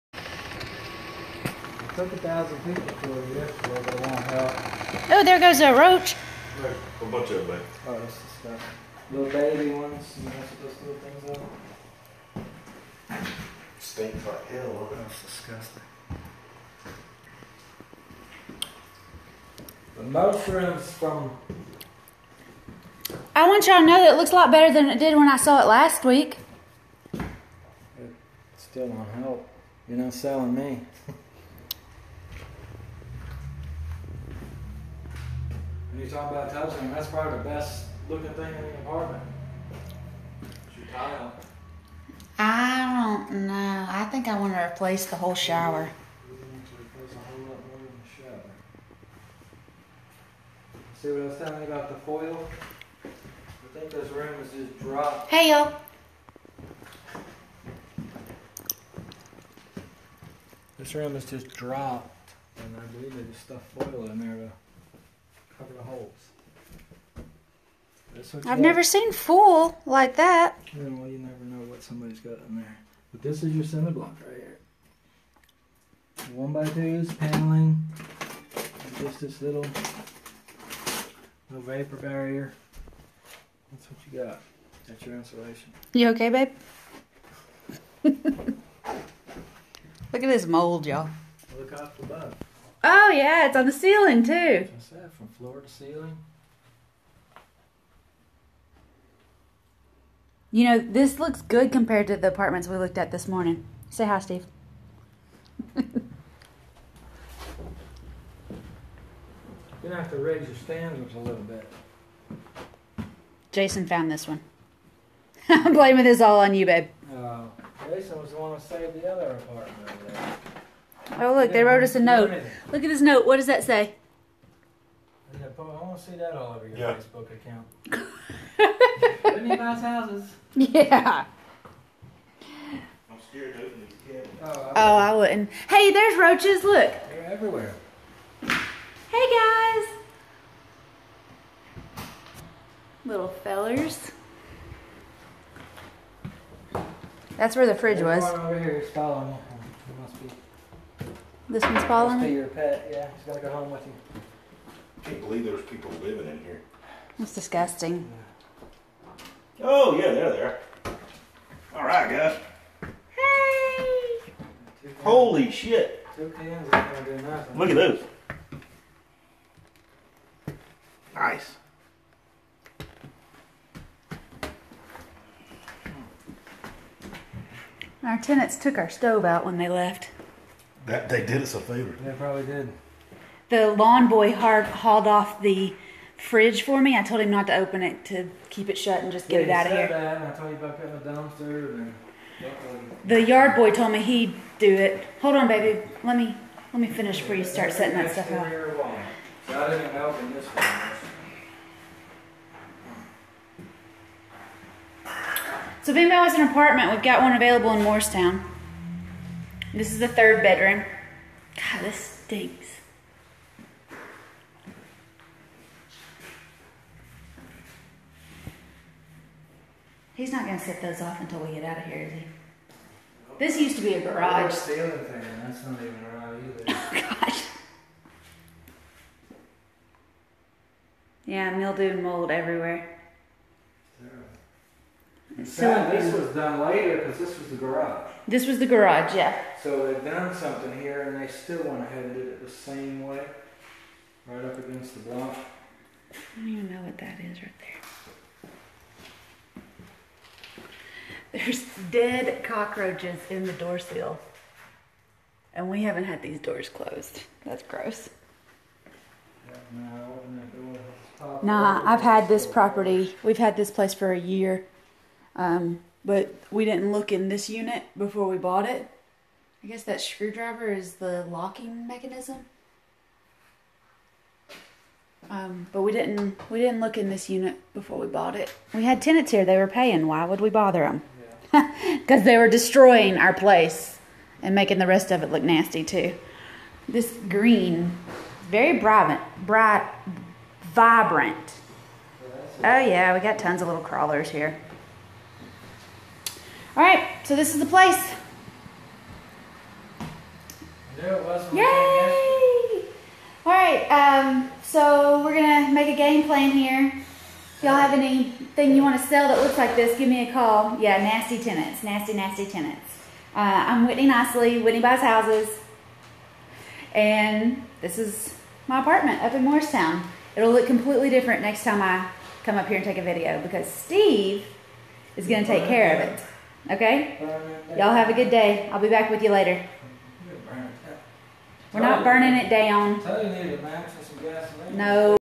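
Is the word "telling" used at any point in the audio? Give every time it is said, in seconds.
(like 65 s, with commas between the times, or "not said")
51 s.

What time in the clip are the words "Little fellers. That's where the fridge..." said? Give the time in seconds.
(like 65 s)
143 s.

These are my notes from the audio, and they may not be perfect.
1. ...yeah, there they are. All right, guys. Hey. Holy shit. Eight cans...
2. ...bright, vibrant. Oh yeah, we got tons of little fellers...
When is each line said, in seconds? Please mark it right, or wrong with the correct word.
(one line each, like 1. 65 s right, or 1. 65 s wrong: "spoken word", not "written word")
1. 159 s wrong: "Two", not "Eight"
2. 289 s wrong: "crawlers", not "fellers".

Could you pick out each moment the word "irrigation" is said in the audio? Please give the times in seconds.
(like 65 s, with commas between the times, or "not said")
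not said.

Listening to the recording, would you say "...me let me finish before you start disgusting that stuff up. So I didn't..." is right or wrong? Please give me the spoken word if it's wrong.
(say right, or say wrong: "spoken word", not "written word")
wrong: "setting", not "disgusting".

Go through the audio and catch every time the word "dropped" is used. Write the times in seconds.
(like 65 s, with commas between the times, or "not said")
54 s, 61 s.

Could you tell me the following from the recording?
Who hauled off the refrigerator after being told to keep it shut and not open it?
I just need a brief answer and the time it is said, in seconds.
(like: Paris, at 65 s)
The lawn boy, at 183 s.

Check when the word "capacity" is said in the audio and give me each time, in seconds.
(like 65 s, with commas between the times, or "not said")
not said.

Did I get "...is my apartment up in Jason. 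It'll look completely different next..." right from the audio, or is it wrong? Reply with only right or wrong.
wrong.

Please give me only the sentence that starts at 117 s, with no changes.
Uh, Jason was the one who saved the other apartment Oh, look, they wrote us a note.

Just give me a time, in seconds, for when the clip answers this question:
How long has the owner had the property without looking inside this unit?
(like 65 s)
264 s.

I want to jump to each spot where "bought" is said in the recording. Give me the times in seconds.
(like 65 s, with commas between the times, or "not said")
268 s, 278 s.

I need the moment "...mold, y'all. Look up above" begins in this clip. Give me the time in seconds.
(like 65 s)
90 s.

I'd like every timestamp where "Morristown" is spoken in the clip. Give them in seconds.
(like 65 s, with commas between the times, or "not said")
207 s, 319 s.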